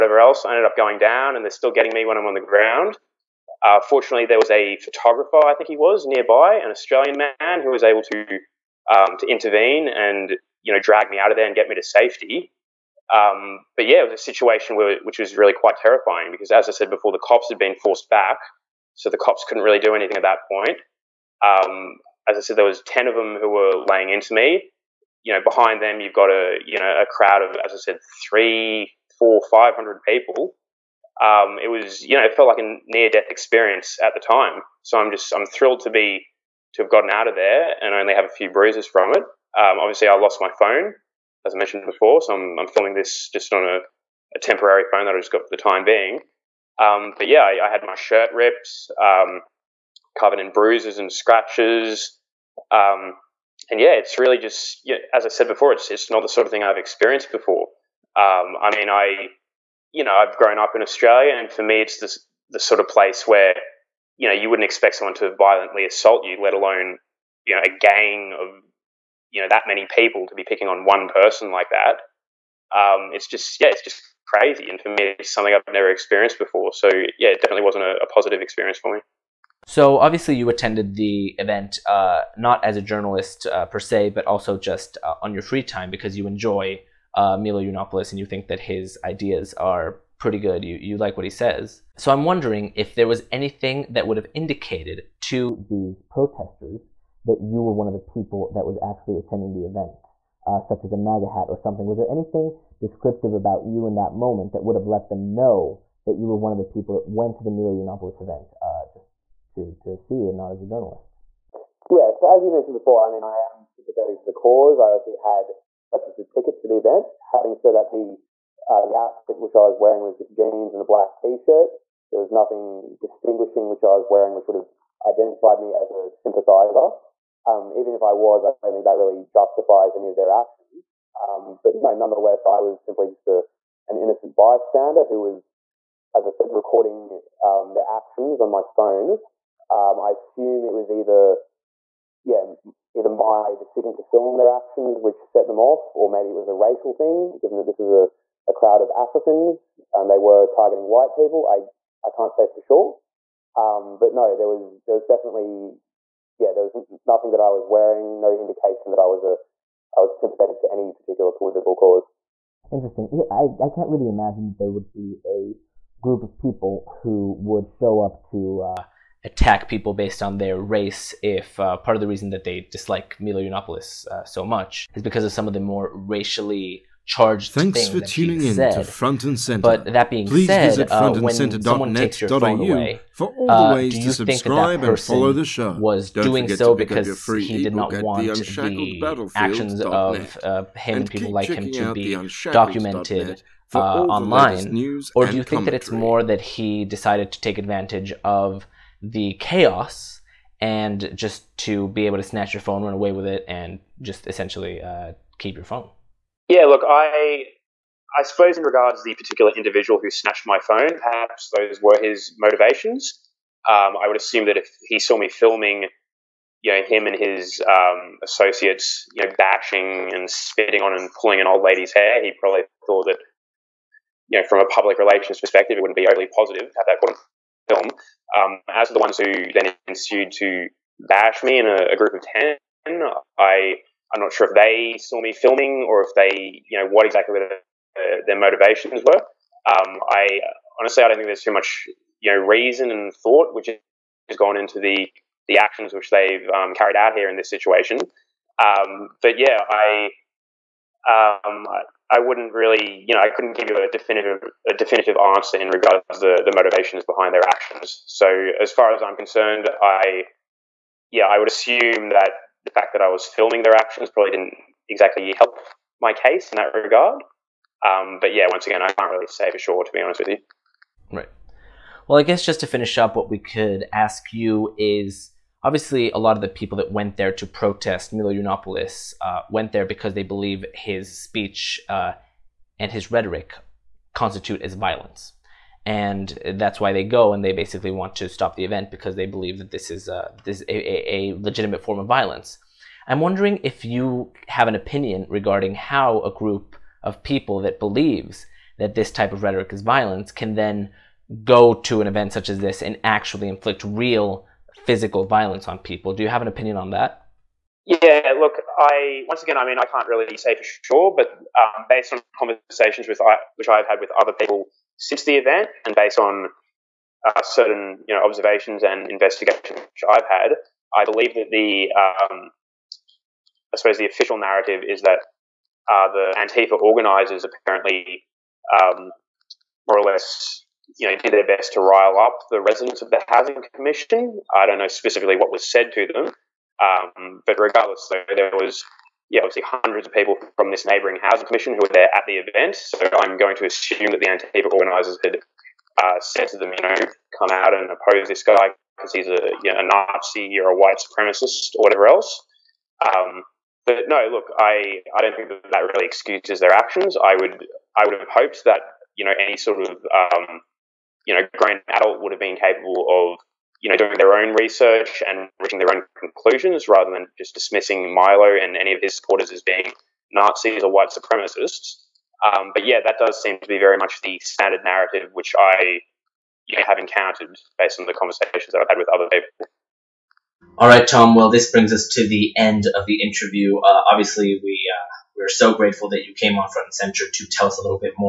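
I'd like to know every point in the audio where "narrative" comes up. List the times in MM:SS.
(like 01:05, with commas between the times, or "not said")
05:24, 06:14.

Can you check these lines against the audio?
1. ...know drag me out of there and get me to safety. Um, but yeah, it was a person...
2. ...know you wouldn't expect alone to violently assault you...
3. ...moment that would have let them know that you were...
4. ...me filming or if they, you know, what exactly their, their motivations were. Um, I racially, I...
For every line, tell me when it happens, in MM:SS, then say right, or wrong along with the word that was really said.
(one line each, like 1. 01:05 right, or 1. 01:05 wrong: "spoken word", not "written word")
1. 00:10 wrong: "situation", not "person"
2. 01:04 wrong: "someone", not "alone"
3. 01:44 right
4. 03:55 wrong: "honestly", not "racially".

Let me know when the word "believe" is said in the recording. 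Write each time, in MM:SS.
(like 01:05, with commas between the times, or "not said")
04:40, 04:49, 04:57, 05:21.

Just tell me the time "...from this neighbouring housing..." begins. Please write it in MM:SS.
05:40.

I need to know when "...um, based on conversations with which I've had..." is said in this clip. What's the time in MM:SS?
05:11.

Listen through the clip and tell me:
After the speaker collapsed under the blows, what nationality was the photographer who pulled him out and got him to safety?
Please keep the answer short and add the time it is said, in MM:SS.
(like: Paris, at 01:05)
Australian, at 00:06.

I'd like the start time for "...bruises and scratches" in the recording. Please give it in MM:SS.
00:50.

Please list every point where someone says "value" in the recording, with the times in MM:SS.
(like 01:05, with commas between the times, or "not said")
not said.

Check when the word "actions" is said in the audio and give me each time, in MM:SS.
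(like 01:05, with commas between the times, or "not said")
02:10, 02:17, 02:24, 03:09, 04:05, 04:17, 04:23, 05:56.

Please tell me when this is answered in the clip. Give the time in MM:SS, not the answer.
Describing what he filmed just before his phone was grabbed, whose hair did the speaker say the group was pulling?
03:41.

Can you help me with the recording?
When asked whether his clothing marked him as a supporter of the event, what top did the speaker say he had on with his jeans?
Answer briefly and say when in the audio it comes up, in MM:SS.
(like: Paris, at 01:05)
A black T-shirt, at 02:00.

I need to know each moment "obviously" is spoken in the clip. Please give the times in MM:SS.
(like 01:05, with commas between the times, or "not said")
00:39, 01:19, 01:54, 04:35, 05:39, 06:24.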